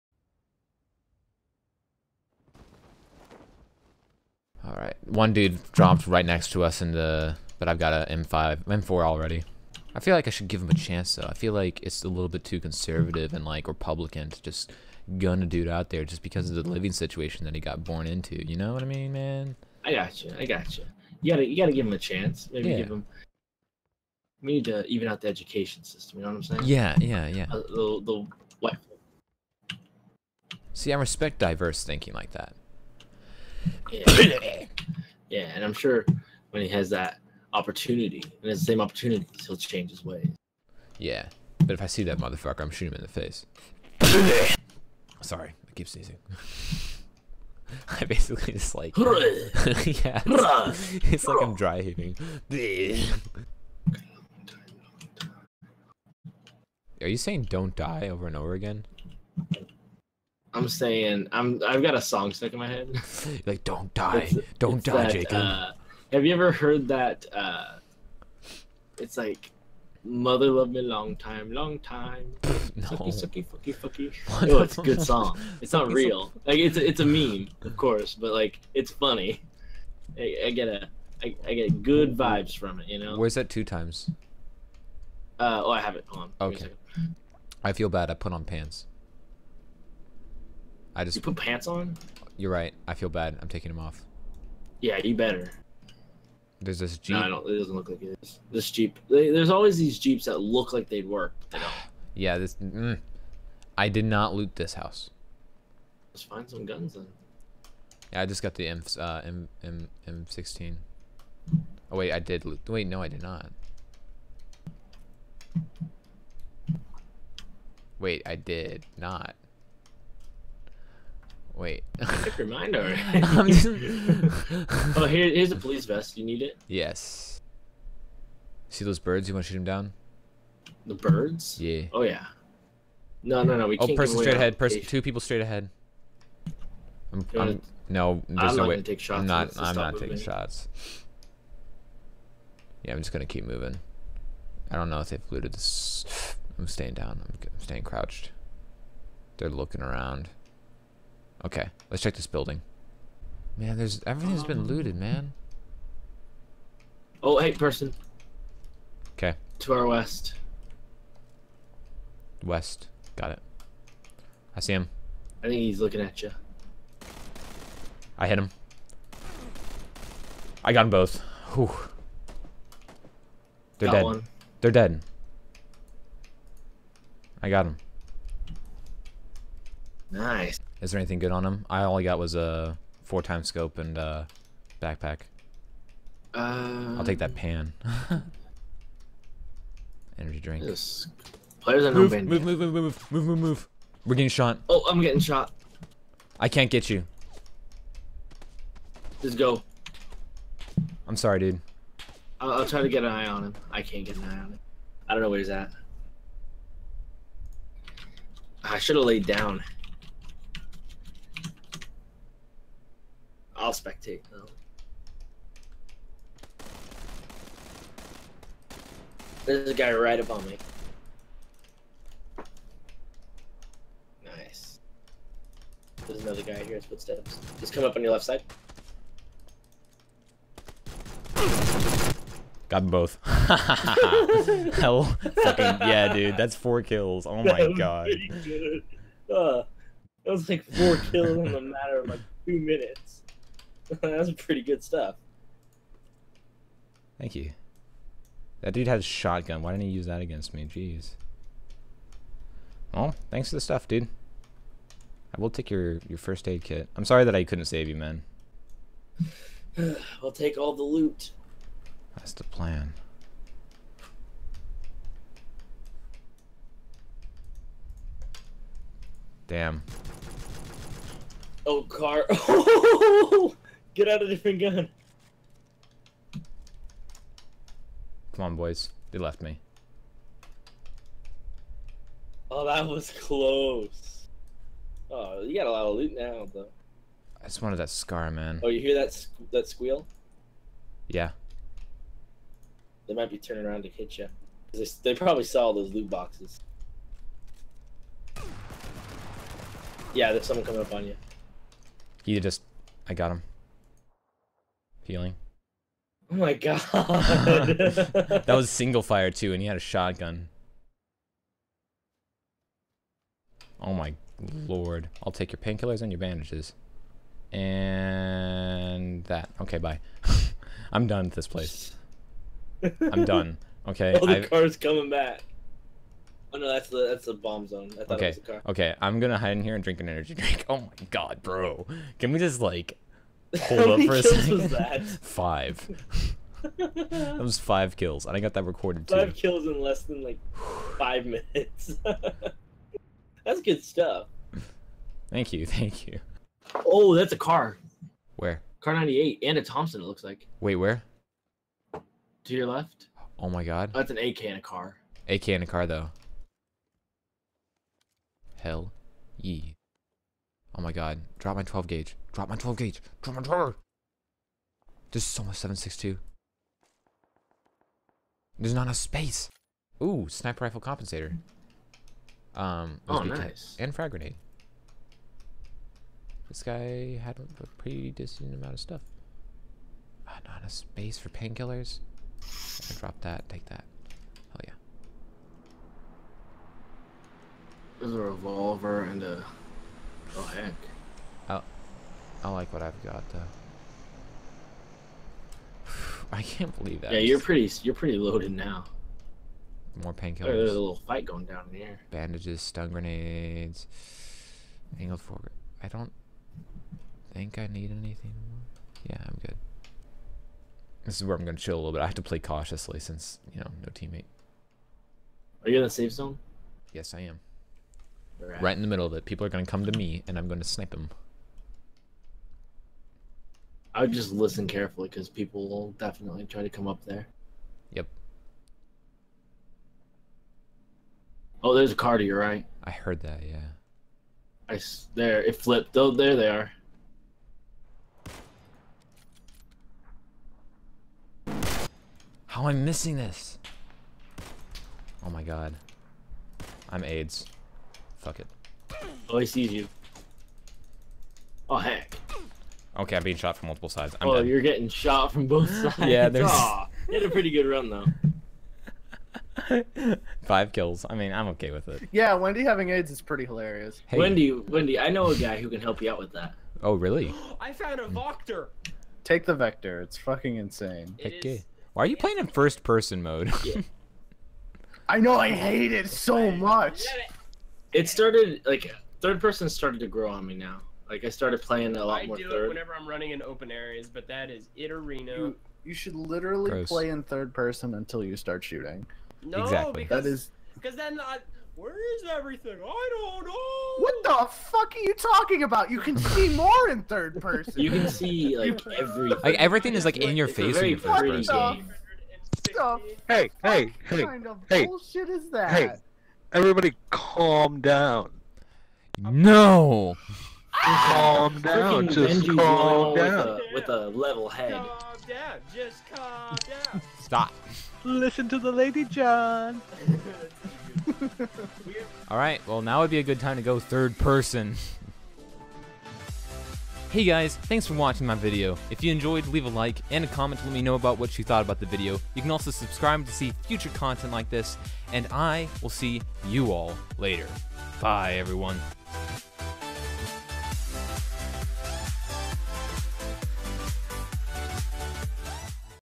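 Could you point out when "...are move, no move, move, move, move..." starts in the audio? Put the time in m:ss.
3:11.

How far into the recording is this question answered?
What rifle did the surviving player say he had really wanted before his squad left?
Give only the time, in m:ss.
4:47.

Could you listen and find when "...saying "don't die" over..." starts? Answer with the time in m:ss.
0:57.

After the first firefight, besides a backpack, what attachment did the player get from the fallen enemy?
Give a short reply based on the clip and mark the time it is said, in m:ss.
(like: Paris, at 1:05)
four times scope, at 3:03.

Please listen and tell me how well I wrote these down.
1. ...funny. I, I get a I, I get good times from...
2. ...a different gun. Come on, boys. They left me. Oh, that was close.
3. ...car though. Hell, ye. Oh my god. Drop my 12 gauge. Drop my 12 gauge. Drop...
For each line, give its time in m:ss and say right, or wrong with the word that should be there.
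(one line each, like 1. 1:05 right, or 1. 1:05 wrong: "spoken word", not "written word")
1. 1:18 wrong: "vibes", not "times"
2. 4:34 right
3. 5:55 right.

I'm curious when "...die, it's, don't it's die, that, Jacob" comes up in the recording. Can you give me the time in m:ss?
1:03.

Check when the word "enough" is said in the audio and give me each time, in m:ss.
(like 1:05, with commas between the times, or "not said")
6:08, 6:20.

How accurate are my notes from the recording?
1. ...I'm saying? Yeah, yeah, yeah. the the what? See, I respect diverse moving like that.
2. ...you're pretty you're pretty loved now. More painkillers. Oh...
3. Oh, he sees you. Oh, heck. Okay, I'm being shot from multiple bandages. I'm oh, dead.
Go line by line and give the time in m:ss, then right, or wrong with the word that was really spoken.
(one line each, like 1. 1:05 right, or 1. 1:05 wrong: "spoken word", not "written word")
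1. 0:26 wrong: "thinking", not "moving"
2. 6:37 wrong: "loaded", not "loved"
3. 7:29 wrong: "sides", not "bandages".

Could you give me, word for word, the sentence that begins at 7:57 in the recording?
It started like third person started to grow on me now.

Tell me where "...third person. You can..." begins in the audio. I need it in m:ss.
8:17.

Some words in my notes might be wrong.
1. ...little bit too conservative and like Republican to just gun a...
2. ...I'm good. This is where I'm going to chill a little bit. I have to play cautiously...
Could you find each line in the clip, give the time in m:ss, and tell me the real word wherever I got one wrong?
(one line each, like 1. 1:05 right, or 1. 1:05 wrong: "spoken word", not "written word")
1. 0:12 right
2. 6:49 right.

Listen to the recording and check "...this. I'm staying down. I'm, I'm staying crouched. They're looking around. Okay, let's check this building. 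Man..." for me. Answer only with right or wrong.
right.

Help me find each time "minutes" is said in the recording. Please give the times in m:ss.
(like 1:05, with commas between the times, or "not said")
4:02, 5:41.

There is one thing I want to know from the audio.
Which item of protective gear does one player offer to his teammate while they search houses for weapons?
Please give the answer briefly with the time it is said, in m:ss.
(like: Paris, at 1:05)
police vest, at 2:05.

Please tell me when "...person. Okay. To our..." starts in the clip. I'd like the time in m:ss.
2:37.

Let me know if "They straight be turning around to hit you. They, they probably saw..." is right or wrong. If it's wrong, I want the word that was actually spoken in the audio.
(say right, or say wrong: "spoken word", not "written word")
wrong: "might", not "straight".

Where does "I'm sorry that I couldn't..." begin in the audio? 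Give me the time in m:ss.
4:16.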